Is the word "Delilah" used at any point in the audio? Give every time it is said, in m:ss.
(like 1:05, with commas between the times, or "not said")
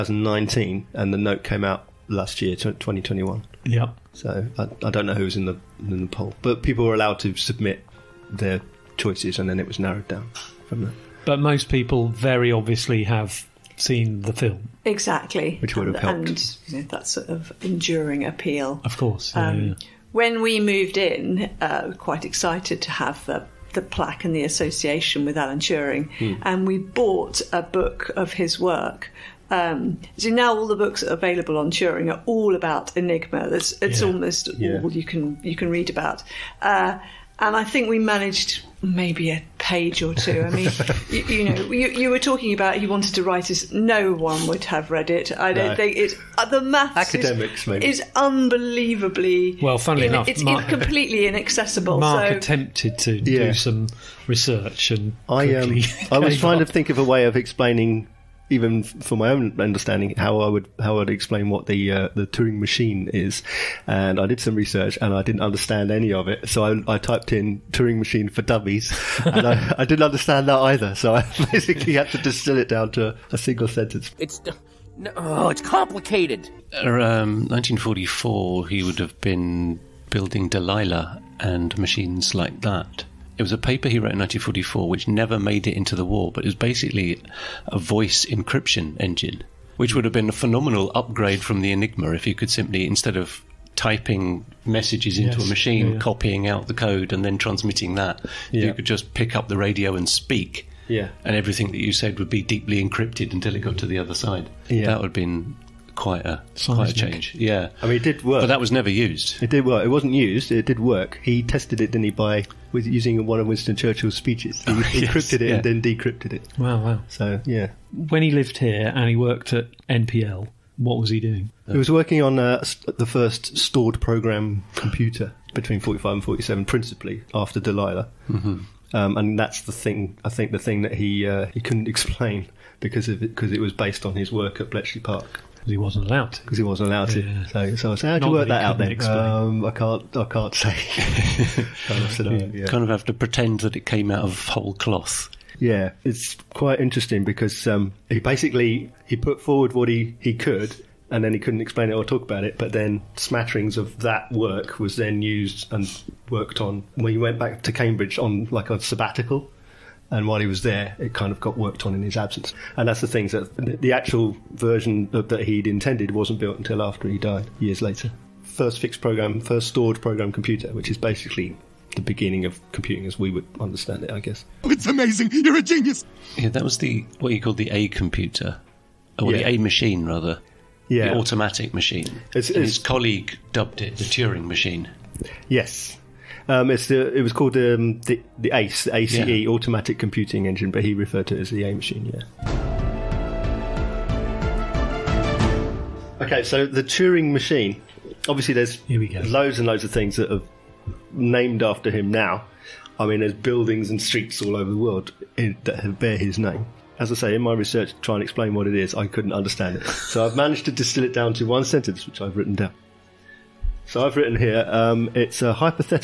1:20, 2:07.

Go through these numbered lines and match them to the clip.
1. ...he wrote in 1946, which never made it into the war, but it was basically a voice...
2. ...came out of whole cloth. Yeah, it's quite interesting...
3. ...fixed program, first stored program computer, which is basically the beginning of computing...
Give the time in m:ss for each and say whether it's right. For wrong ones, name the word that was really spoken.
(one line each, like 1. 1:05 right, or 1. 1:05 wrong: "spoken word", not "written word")
1. 1:23 wrong: "1944", not "1946"
2. 2:23 right
3. 2:48 right.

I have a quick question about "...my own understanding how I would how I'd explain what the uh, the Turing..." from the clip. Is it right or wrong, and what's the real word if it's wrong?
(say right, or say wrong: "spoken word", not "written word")
right.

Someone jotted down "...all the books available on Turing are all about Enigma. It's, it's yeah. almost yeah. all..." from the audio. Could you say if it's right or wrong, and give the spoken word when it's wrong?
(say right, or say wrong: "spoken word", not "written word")
right.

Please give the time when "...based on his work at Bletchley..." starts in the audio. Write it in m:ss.
2:13.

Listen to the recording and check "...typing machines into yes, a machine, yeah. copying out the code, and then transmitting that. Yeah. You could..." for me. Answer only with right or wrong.
wrong.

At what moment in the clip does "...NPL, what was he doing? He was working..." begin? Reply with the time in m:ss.
1:59.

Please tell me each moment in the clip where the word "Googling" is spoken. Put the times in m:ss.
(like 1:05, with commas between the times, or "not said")
not said.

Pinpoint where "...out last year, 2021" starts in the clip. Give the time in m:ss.
0:01.